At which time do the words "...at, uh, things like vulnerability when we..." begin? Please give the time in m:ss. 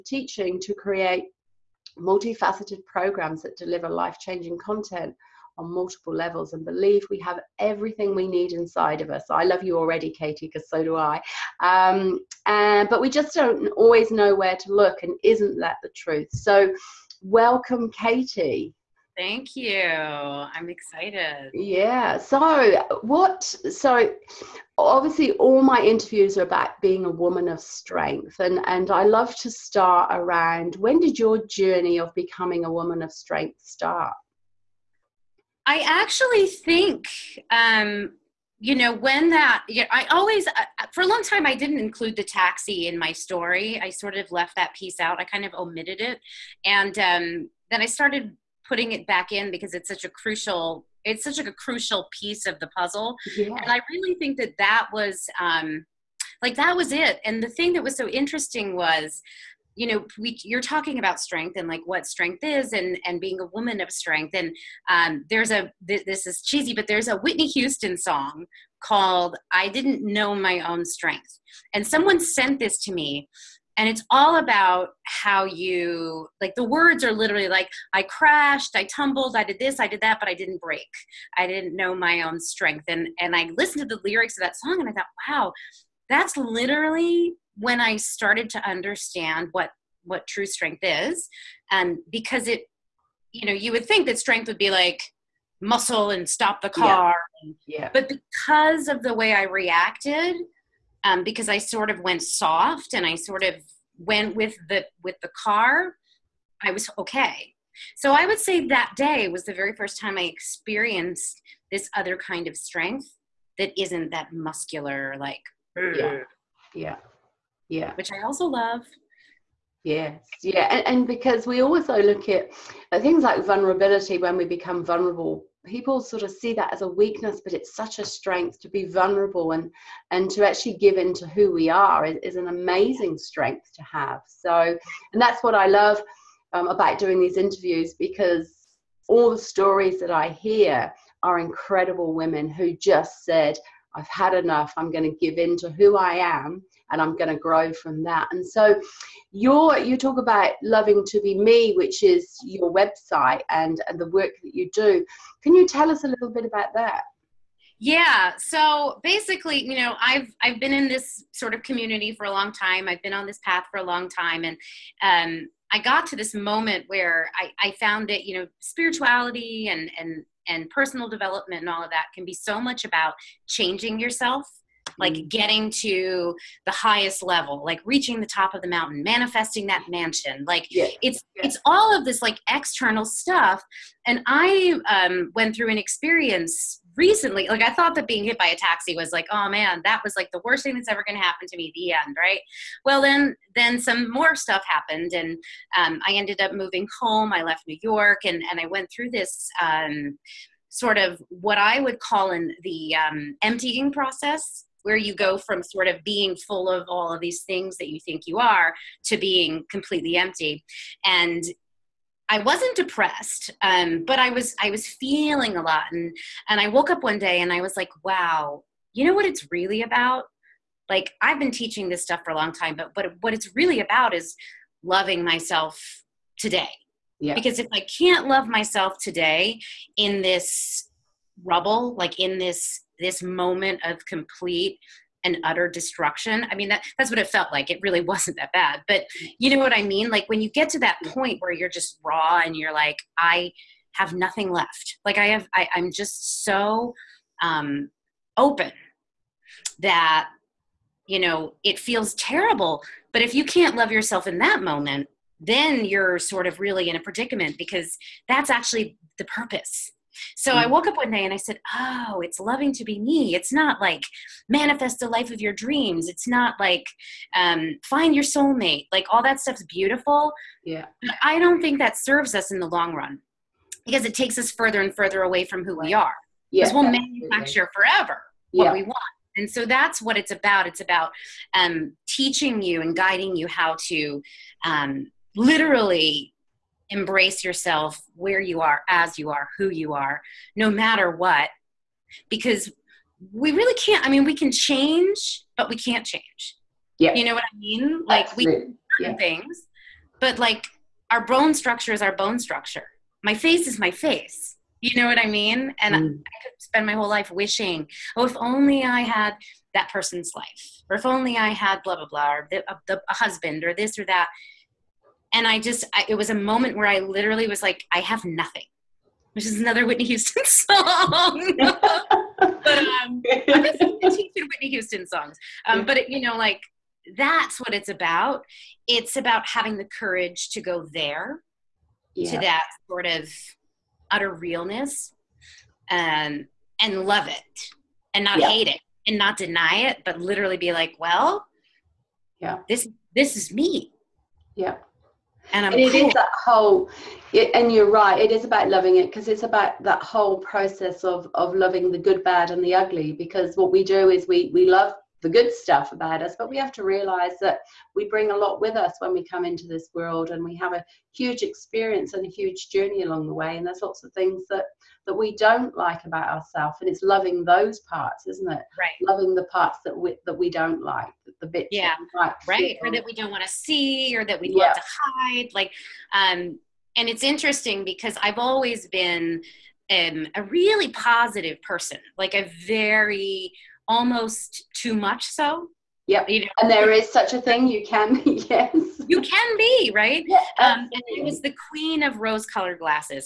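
2:02.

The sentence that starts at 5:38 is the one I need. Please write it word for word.
hate it and not deny it, but literally be like, well, yeah, this, this is me.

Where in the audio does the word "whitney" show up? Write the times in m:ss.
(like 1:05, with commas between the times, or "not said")
1:07, 5:19, 5:24.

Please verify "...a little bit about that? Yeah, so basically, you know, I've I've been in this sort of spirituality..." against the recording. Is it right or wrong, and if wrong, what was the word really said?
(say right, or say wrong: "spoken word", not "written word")
wrong: "community", not "spirituality".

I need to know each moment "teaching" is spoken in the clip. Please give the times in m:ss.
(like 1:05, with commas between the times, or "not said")
0:00, 3:41, 4:42, 5:23.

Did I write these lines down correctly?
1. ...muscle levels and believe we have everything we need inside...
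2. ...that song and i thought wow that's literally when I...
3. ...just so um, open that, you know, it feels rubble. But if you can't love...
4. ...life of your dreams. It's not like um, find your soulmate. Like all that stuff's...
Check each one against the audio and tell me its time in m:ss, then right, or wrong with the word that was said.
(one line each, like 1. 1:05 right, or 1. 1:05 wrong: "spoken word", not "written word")
1. 0:05 wrong: "multiple", not "muscle"
2. 1:24 right
3. 4:05 wrong: "terrible", not "rubble"
4. 4:25 right.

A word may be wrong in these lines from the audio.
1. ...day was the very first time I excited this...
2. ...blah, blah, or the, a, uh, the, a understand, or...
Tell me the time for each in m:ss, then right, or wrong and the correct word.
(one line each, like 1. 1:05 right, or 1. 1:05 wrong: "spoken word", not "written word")
1. 1:48 wrong: "experienced", not "excited"
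2. 5:11 wrong: "husband", not "understand".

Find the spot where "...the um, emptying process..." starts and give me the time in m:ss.
3:22.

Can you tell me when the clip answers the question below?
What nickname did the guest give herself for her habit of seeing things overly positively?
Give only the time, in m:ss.
6:31.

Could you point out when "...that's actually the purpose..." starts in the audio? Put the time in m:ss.
4:18.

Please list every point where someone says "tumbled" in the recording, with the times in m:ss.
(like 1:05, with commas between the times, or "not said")
1:18.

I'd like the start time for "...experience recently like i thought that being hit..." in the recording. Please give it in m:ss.
3:05.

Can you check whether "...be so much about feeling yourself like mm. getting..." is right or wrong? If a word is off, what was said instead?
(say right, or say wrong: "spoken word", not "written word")
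wrong: "changing", not "feeling".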